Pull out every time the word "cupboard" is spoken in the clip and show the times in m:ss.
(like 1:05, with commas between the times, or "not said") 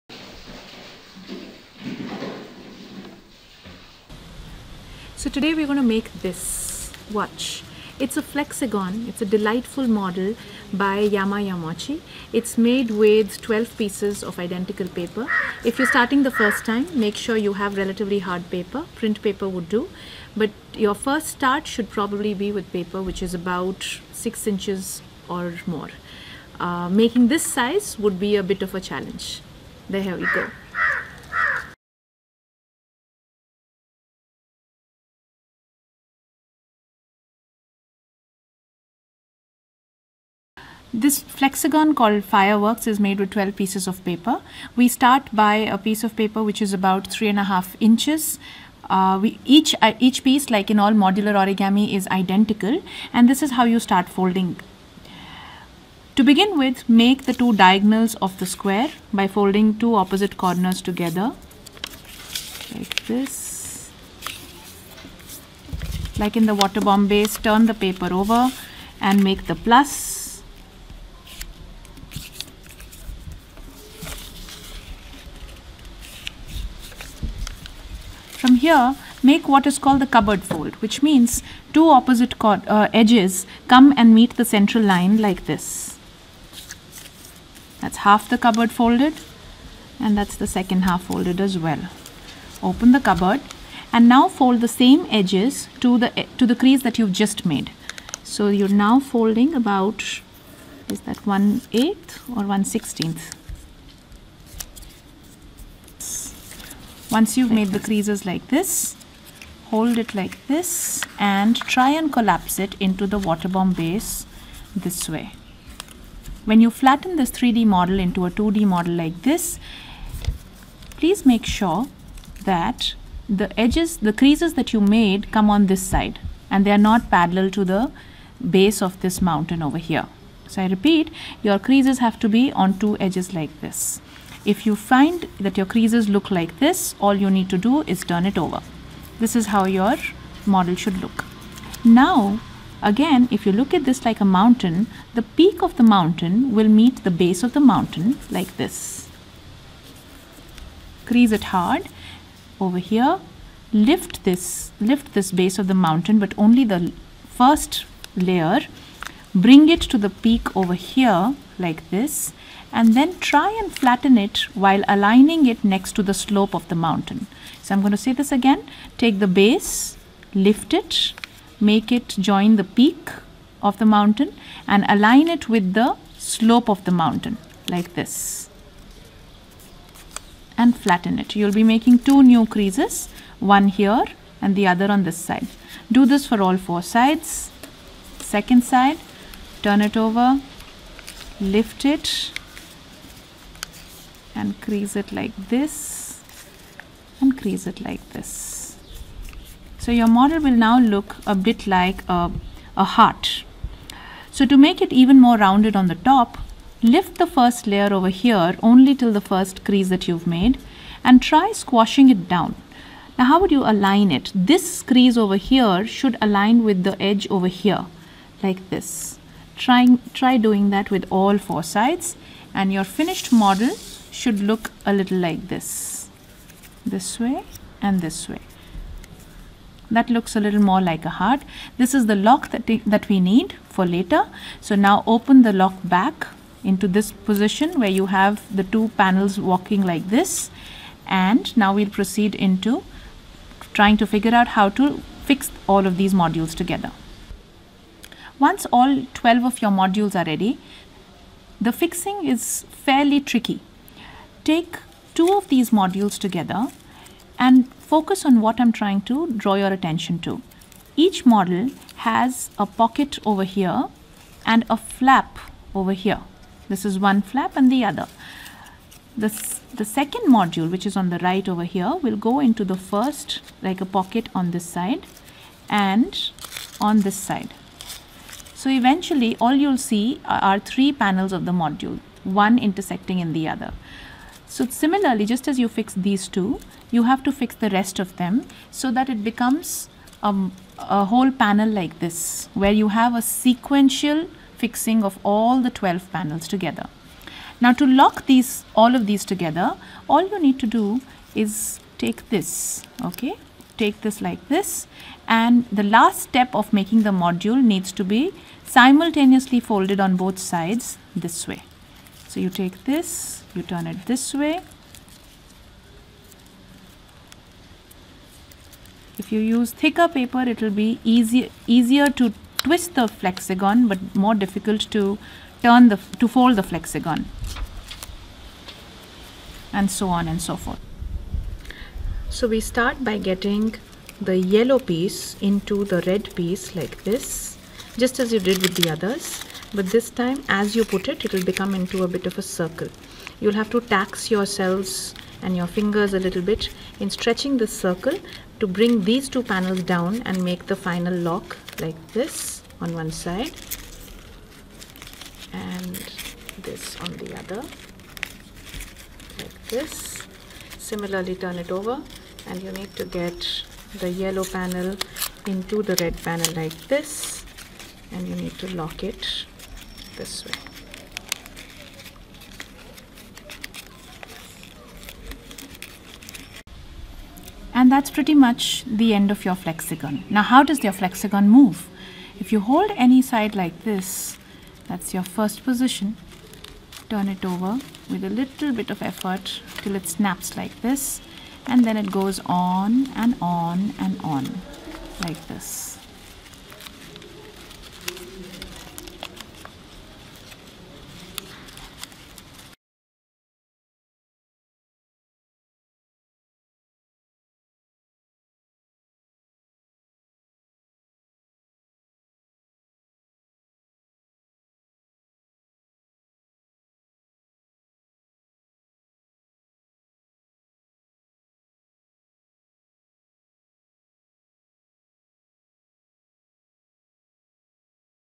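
1:20, 1:28, 1:32.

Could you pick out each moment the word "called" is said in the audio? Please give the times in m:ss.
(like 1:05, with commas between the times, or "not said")
0:41, 1:19.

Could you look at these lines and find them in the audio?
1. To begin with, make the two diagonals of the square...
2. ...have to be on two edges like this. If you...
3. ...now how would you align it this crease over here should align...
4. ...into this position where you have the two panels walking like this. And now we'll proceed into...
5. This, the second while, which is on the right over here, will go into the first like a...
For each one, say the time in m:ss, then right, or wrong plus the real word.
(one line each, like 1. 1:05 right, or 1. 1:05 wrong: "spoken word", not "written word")
1. 0:56 right
2. 2:11 right
3. 3:33 right
4. 3:56 right
5. 4:29 wrong: "module", not "while".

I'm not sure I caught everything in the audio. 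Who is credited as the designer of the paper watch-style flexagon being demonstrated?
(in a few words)
Yami Yamauchi.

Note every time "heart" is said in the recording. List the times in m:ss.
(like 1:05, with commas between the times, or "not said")
3:22, 3:51.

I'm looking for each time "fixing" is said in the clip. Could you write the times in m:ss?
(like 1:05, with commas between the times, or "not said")
4:11, 4:54.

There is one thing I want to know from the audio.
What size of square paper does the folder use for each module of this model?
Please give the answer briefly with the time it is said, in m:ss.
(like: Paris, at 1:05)
3.5 inches, at 0:47.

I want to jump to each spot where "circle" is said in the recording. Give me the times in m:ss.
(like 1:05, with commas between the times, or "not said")
5:42, 5:47.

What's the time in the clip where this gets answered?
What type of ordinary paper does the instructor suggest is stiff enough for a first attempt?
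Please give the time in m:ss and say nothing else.
0:18.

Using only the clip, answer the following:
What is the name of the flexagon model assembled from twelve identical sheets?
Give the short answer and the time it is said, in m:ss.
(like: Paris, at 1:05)
fireworks, at 0:42.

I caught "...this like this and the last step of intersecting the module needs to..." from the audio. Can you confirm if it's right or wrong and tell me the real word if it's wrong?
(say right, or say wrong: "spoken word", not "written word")
wrong: "making", not "intersecting".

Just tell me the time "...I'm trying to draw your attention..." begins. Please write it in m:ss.
4:18.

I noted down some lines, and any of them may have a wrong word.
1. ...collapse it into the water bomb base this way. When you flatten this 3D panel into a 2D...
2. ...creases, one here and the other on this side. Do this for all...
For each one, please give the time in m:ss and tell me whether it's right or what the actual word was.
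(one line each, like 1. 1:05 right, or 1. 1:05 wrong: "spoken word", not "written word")
1. 1:52 wrong: "model", not "panel"
2. 3:02 right.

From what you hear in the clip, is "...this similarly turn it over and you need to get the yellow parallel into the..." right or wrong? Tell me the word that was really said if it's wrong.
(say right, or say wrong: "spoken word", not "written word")
wrong: "panel", not "parallel".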